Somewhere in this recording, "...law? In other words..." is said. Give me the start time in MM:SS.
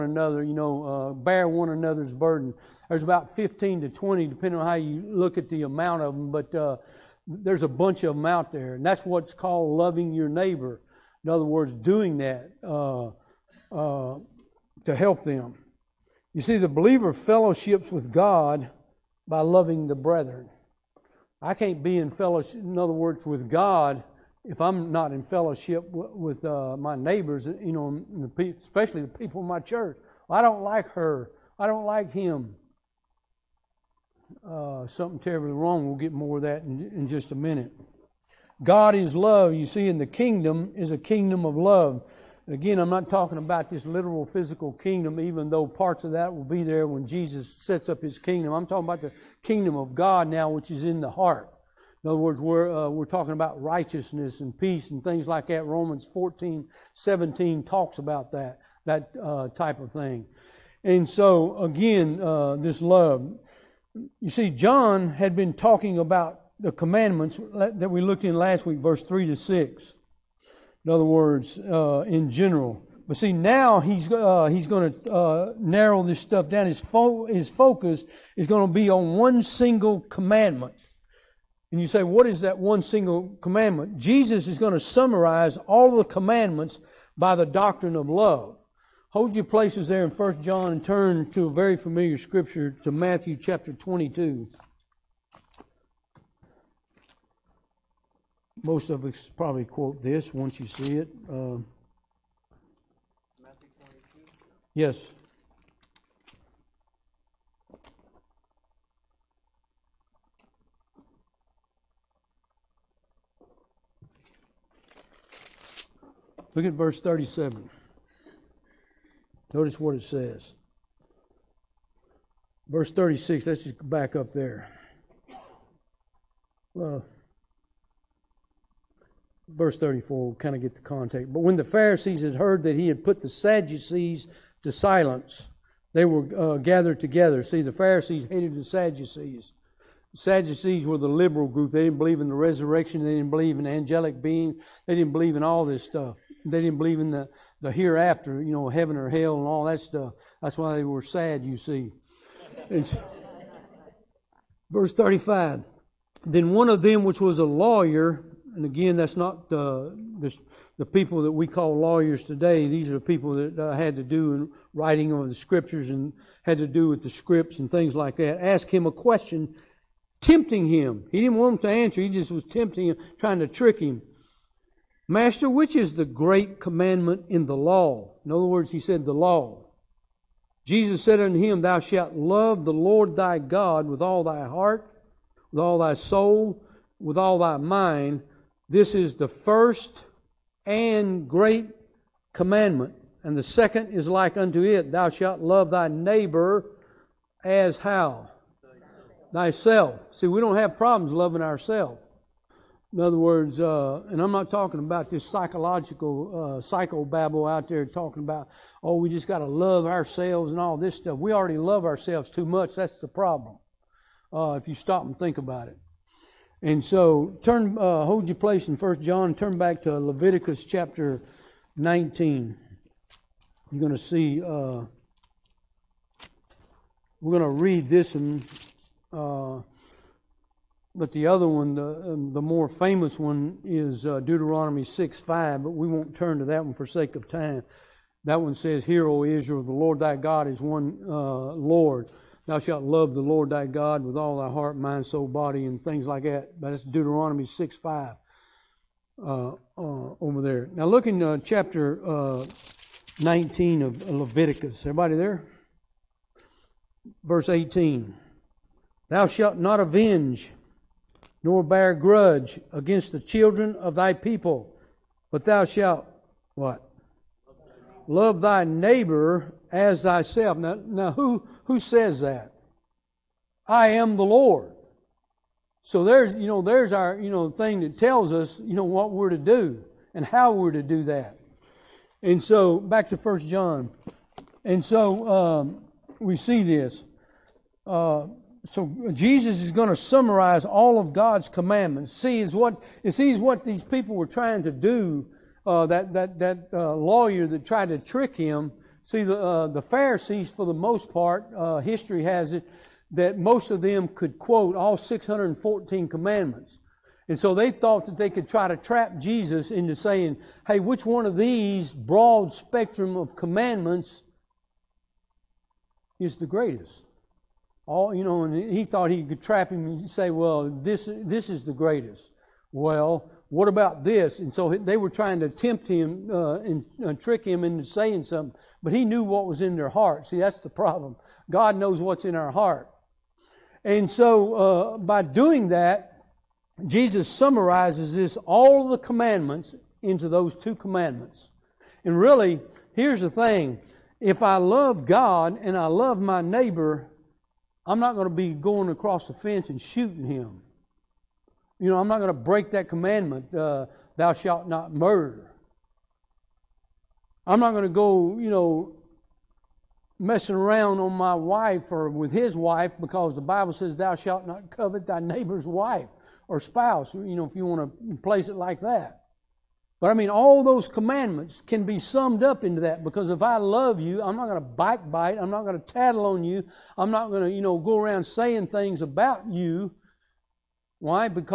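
02:57.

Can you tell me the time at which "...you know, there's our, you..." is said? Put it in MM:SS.
04:36.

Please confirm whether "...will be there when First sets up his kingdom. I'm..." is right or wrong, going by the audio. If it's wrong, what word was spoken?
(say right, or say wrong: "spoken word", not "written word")
wrong: "Jesus", not "First".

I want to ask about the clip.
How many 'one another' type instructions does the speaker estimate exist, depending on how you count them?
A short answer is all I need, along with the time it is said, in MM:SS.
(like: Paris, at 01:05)
15 to 20, at 00:03.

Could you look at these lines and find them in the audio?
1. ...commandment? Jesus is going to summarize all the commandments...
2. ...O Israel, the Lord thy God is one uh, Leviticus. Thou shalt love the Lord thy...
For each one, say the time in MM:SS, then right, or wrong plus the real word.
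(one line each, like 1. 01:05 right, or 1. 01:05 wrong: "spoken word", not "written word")
1. 01:23 right
2. 03:59 wrong: "Lord", not "Leviticus".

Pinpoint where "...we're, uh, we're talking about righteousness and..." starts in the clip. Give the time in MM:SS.
00:52.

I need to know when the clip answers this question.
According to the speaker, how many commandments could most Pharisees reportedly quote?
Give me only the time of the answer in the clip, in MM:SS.
05:04.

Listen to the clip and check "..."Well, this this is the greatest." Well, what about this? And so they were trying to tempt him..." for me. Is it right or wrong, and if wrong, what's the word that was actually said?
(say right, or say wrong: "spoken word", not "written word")
right.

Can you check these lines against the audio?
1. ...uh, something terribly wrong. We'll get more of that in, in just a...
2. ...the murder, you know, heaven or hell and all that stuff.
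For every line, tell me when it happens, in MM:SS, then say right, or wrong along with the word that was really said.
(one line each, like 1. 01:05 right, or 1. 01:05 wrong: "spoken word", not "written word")
1. 00:34 right
2. 02:27 wrong: "hereafter", not "murder".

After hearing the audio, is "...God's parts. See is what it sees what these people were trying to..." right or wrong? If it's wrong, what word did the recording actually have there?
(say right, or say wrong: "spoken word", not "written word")
wrong: "commandments", not "parts".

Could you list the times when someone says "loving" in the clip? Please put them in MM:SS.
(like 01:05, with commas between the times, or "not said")
00:09, 00:19, 03:21.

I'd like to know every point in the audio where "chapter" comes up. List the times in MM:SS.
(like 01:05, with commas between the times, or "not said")
01:33, 03:40, 04:11.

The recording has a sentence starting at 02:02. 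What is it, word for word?
Verse 36, let's just back up there.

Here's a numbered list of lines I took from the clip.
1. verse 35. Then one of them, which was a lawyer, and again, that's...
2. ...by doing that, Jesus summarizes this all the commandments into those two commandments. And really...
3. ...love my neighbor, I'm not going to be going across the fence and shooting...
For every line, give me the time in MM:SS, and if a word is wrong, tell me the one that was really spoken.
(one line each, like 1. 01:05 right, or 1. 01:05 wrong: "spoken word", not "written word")
1. 02:34 right
2. 05:34 right
3. 05:45 right.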